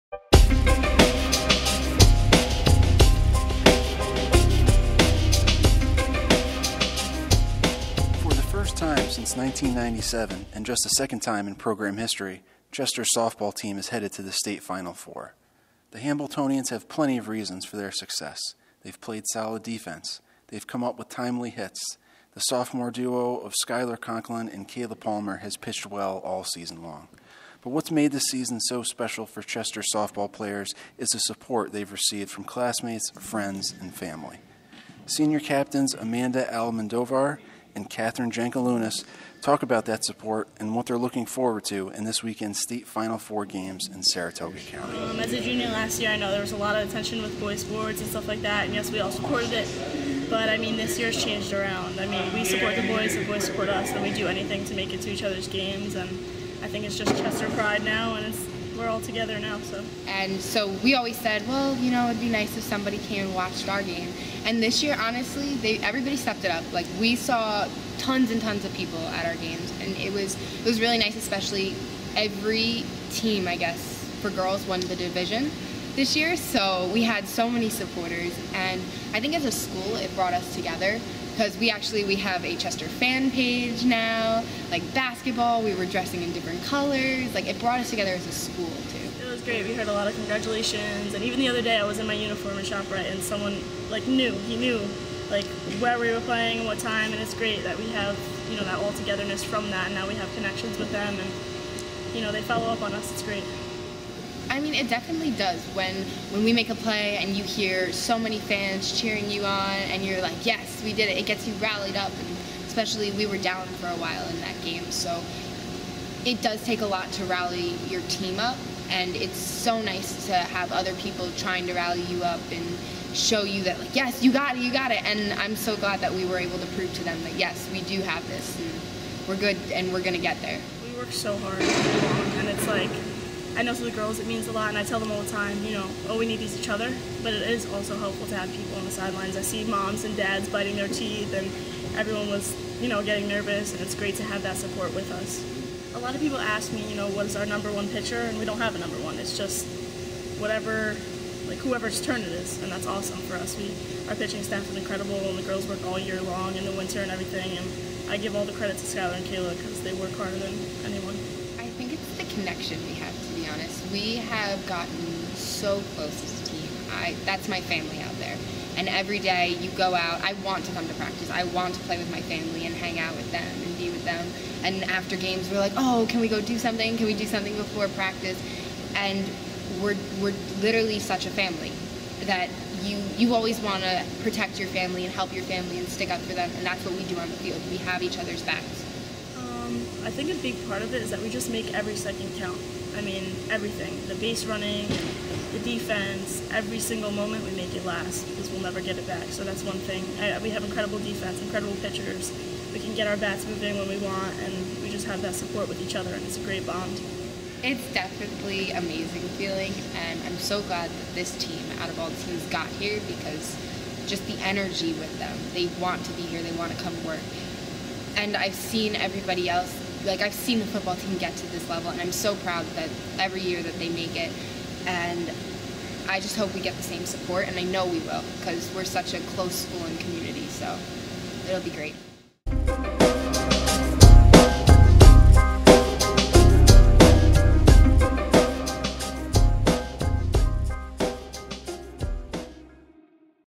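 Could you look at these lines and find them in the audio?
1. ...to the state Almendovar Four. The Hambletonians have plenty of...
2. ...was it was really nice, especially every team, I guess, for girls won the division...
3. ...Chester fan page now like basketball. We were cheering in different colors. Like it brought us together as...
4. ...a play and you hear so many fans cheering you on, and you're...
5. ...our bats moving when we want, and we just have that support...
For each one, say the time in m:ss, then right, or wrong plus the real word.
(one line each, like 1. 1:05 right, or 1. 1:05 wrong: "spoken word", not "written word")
1. 0:14 wrong: "Final", not "Almendovar"
2. 1:10 right
3. 1:22 wrong: "dressing", not "cheering"
4. 1:46 right
5. 3:23 right.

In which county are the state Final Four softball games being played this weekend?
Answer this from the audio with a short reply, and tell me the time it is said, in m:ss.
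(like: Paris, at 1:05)
Saratoga County, at 0:44.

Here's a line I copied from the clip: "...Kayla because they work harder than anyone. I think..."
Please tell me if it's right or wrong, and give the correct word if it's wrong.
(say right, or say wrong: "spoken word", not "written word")
right.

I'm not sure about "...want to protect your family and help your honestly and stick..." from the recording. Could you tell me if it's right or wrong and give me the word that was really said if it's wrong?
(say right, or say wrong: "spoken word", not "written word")
wrong: "family", not "honestly".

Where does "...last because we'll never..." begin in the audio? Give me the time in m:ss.
3:17.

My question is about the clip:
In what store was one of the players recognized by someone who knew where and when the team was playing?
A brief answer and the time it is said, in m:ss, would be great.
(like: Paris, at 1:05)
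ShopRite, at 1:32.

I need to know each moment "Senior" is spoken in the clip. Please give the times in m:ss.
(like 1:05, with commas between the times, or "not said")
0:35.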